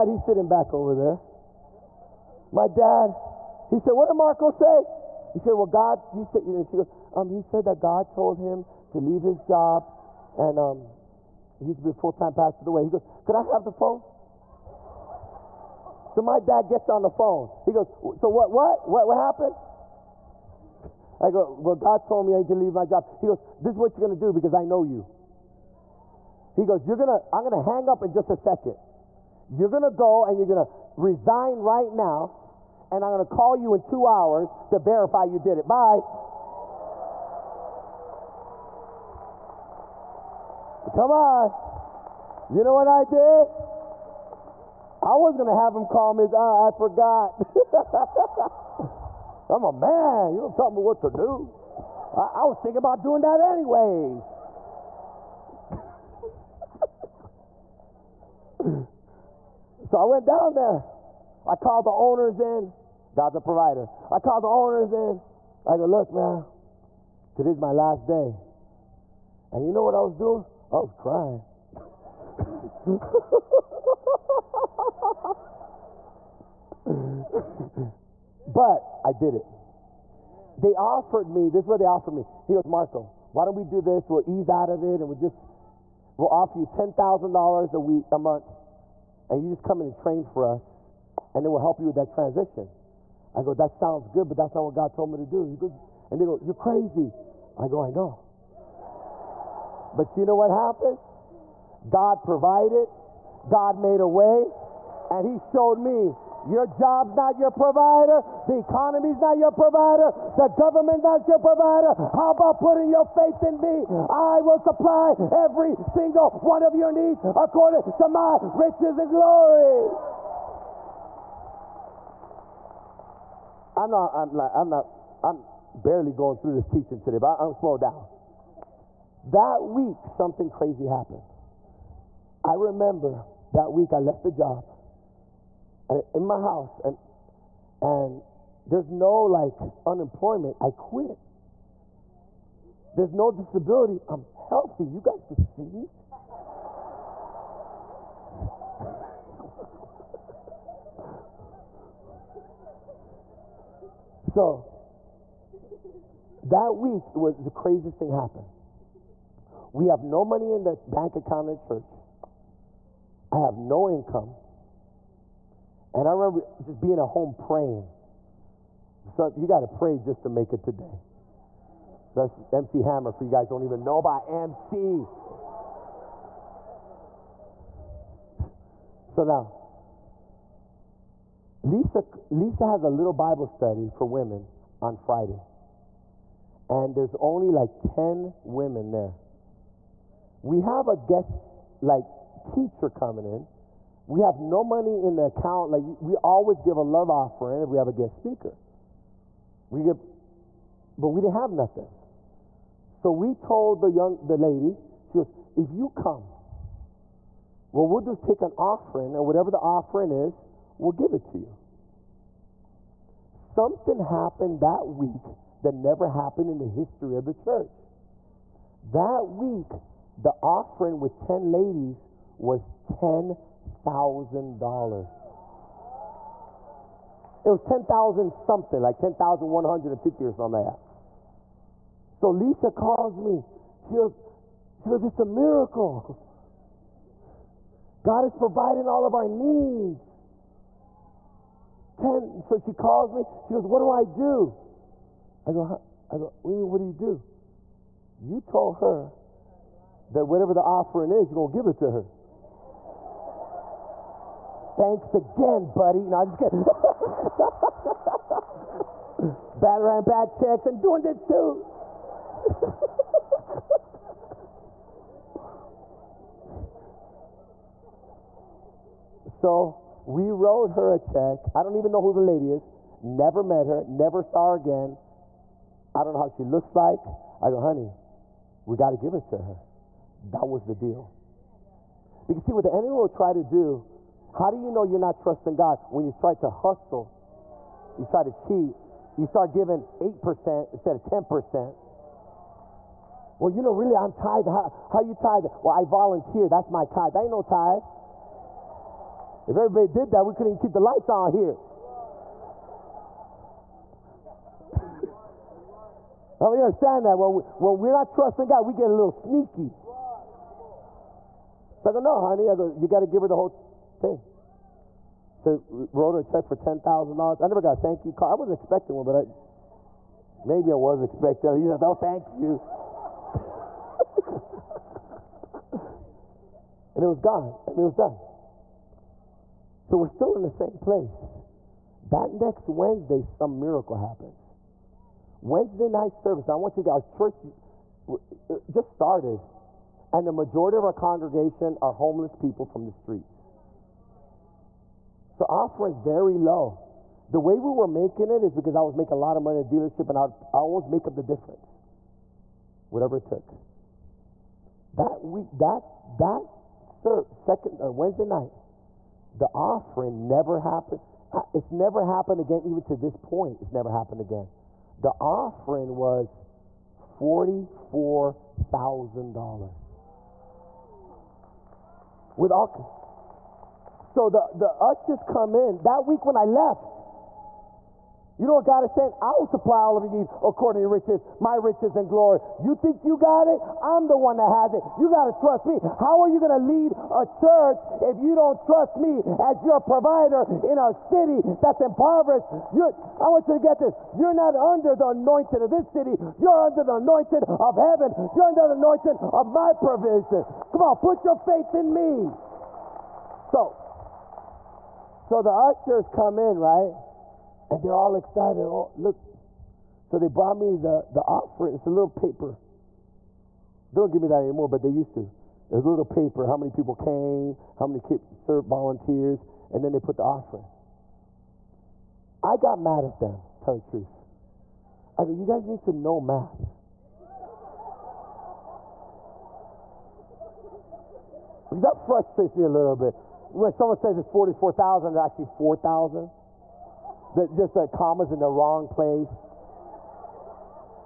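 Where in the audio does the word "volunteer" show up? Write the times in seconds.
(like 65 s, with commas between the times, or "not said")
295 s, 418 s.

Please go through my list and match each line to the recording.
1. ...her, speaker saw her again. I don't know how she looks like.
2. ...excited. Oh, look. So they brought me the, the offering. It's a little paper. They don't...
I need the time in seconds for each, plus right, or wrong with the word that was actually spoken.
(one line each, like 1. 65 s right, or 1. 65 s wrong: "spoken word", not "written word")
1. 273 s wrong: "never", not "speaker"
2. 408 s right.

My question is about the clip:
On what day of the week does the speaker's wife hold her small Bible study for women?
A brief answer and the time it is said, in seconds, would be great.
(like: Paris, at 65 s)
Friday, at 184 s.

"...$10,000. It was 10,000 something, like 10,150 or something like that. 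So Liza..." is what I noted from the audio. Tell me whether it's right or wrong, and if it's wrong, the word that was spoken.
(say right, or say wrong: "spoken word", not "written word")
right.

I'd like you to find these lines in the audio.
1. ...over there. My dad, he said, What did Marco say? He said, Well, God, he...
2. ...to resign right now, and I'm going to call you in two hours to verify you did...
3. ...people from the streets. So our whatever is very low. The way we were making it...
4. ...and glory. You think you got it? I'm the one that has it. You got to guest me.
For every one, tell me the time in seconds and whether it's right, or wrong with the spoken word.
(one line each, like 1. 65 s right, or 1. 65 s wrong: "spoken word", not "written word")
1. 0 s right
2. 30 s right
3. 342 s wrong: "offer", not "whatever"
4. 381 s wrong: "trust", not "guest".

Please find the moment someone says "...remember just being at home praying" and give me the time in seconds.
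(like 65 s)
166 s.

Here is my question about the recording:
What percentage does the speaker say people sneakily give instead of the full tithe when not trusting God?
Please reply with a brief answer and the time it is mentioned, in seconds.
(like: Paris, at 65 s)
8%, at 289 s.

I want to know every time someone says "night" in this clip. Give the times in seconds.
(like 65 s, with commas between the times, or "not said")
335 s, 358 s.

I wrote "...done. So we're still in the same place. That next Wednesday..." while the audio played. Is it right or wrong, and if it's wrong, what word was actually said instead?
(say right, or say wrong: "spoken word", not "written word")
right.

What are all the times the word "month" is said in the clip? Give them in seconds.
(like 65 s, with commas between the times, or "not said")
88 s.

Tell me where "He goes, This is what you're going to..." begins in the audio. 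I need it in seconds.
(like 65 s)
23 s.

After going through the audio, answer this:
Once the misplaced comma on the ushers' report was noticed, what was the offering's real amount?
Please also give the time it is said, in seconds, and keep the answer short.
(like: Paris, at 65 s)
$4,000, at 435 s.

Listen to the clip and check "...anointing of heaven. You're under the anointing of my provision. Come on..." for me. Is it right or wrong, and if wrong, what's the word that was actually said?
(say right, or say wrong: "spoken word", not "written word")
right.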